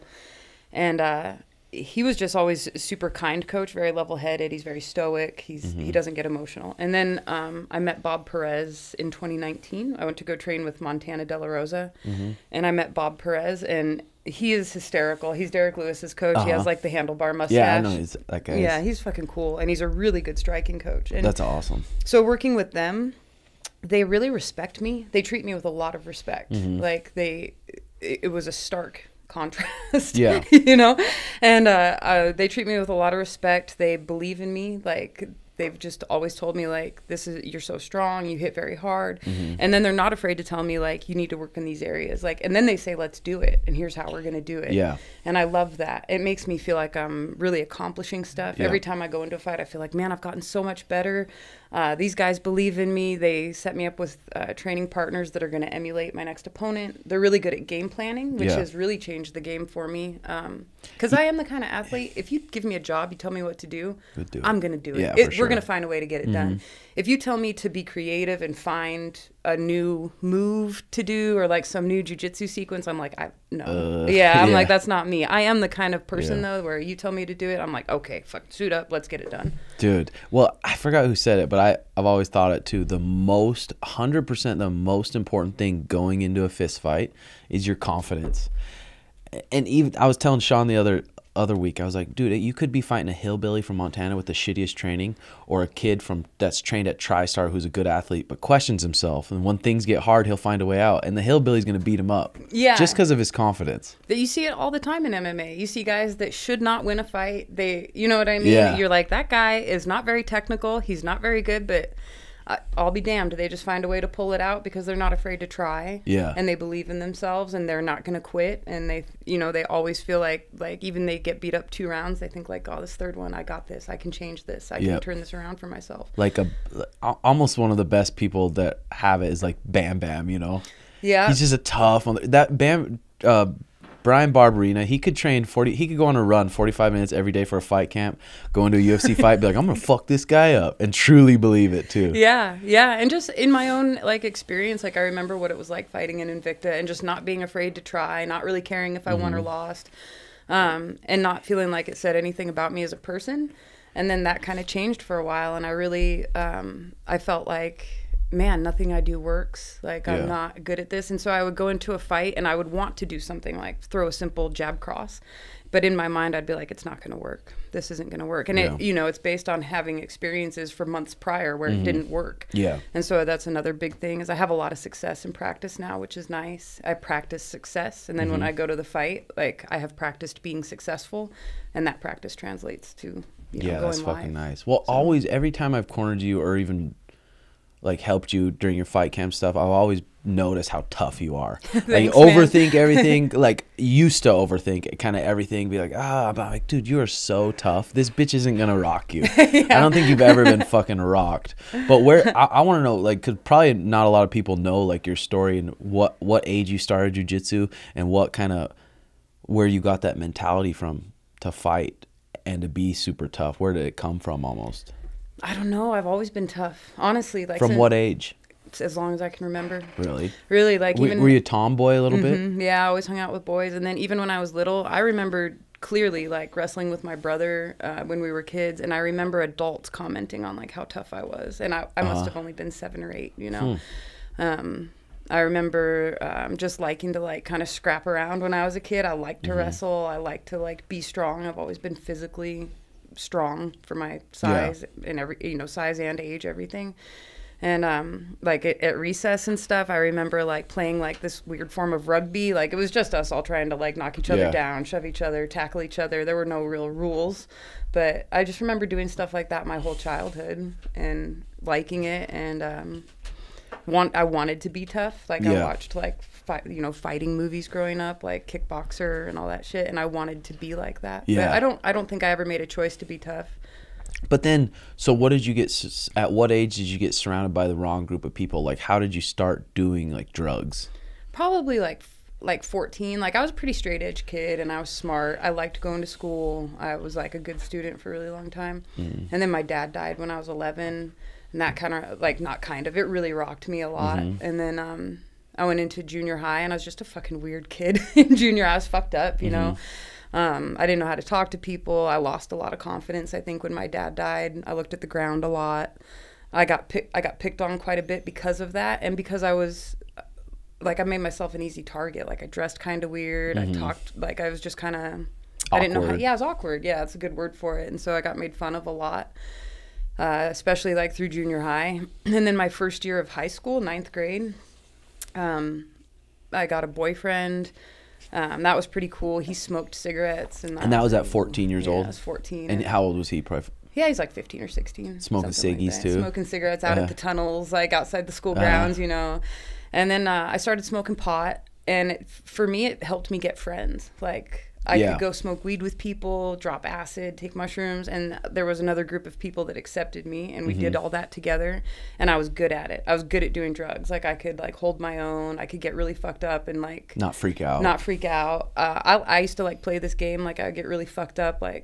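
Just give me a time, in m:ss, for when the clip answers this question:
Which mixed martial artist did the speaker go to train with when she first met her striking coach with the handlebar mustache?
0:10.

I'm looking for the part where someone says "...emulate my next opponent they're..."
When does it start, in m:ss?
0:55.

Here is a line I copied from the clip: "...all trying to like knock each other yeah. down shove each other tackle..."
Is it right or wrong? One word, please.
right.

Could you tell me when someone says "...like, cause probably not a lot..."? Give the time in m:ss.
3:22.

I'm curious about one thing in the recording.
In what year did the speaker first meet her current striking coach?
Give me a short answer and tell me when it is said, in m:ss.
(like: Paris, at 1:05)
2019, at 0:09.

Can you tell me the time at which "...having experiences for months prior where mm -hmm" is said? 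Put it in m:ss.
2:49.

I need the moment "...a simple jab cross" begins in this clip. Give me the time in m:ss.
2:44.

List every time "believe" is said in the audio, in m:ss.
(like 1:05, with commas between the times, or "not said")
0:33, 0:52, 1:56, 2:21.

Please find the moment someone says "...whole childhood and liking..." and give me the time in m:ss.
4:19.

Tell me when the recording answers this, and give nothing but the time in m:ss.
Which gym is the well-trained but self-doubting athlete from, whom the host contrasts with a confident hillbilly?
1:36.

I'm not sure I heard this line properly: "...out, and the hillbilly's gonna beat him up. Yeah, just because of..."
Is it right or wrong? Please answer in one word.
right.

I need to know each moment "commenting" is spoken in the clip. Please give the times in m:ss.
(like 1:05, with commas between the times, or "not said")
3:49.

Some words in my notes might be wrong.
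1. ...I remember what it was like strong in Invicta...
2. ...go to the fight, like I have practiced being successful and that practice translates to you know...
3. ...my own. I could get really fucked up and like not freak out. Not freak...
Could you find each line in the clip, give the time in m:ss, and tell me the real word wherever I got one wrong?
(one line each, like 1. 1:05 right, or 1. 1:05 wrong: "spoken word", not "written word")
1. 2:24 wrong: "fighting", not "strong"
2. 2:58 right
3. 5:55 right.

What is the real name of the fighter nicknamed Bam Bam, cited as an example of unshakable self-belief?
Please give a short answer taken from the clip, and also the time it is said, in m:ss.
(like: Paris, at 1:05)
Bryan Barberena, at 2:14.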